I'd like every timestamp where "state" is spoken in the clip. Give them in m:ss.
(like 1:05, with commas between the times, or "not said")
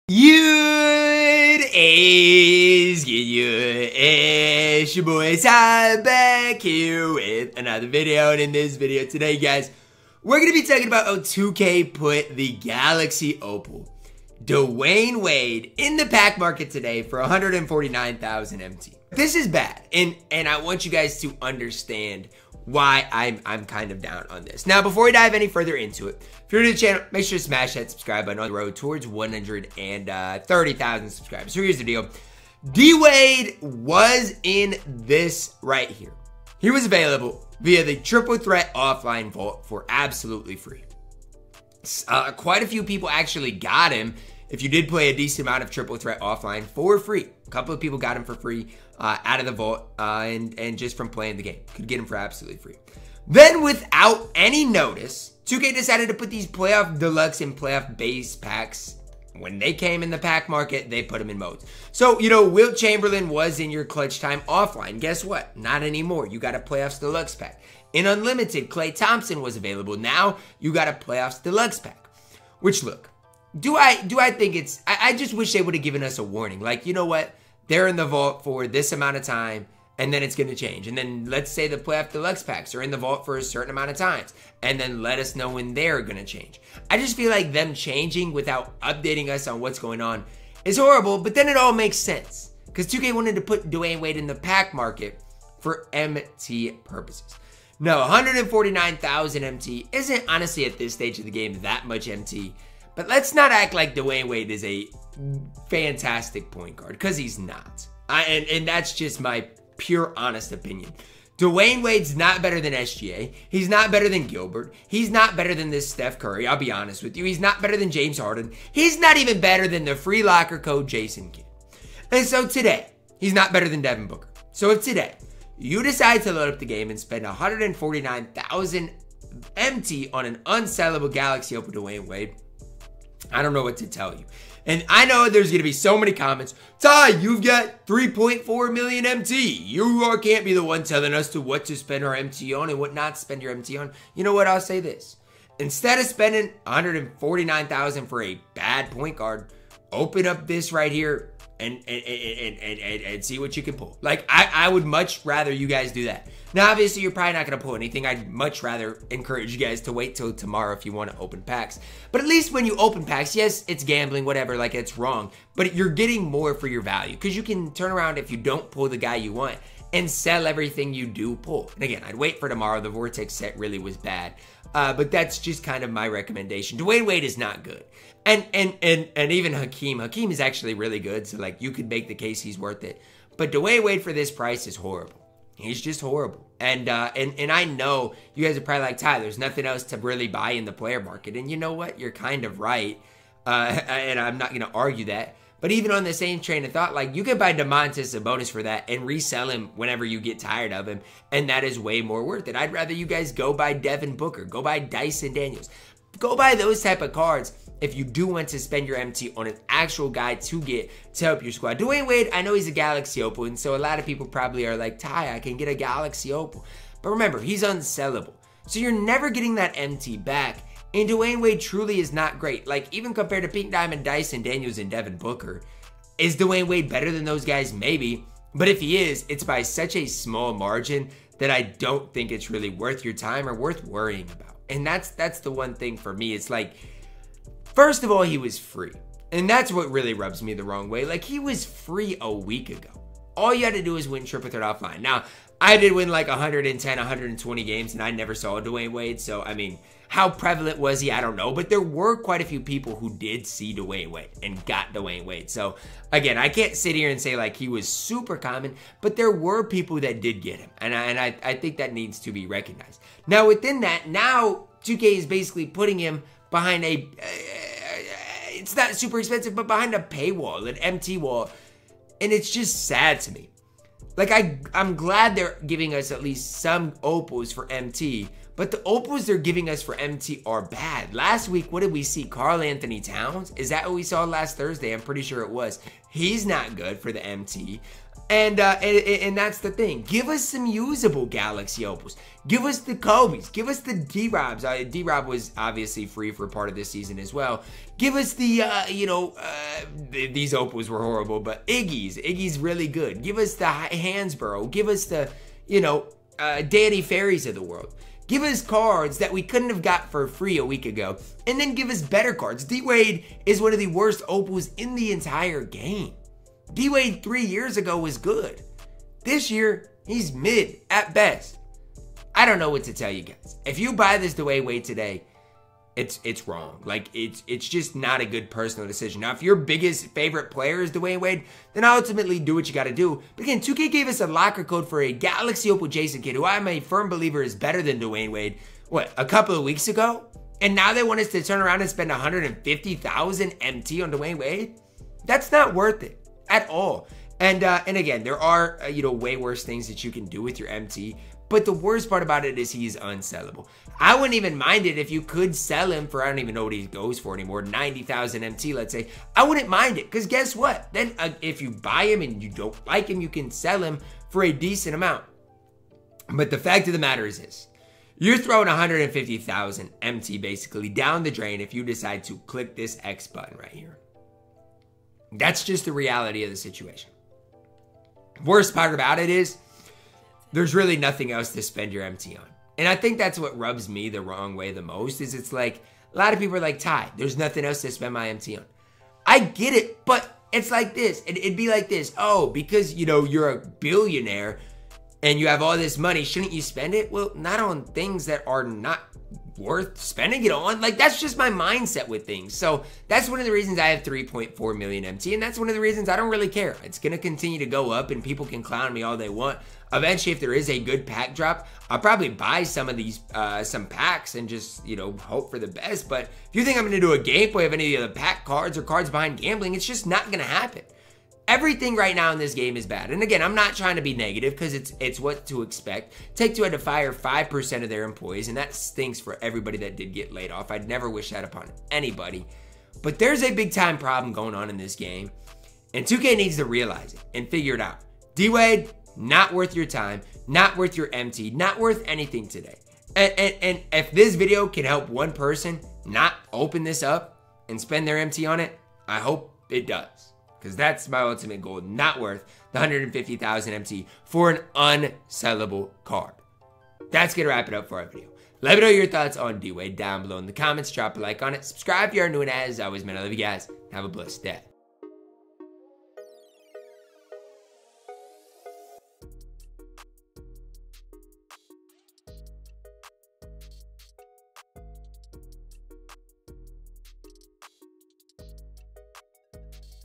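not said.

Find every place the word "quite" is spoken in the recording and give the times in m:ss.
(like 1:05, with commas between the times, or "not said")
0:42, 4:12.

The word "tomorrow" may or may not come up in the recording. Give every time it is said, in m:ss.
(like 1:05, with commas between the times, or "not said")
2:40, 2:52.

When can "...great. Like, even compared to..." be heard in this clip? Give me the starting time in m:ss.
3:42.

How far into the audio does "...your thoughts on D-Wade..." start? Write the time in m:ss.
7:38.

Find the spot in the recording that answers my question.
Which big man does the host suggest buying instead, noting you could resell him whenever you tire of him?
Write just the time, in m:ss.
3:17.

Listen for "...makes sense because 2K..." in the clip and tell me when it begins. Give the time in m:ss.
1:31.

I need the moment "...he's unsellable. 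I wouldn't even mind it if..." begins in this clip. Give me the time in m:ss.
5:52.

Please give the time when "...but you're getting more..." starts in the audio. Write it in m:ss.
2:45.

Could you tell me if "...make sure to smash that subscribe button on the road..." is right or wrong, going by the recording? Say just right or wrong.
right.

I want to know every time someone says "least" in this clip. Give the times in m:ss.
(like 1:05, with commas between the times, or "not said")
2:42, 4:36.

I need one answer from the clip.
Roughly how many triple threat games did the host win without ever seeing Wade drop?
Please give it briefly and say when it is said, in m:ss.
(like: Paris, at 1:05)
110 to 120, at 4:06.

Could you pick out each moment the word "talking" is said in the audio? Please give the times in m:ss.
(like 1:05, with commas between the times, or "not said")
0:10.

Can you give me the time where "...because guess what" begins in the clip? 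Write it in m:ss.
6:00.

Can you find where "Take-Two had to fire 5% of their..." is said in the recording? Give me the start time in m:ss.
7:06.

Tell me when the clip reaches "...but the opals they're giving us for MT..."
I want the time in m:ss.
4:38.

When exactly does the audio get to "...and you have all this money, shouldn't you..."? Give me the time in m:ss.
6:35.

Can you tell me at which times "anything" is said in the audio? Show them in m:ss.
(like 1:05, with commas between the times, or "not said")
2:37, 7:22.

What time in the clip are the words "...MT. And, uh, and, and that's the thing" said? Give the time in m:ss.
4:47.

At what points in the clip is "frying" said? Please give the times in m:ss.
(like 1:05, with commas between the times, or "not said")
not said.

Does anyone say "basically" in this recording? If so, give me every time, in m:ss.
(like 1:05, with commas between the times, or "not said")
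4:25, 6:10.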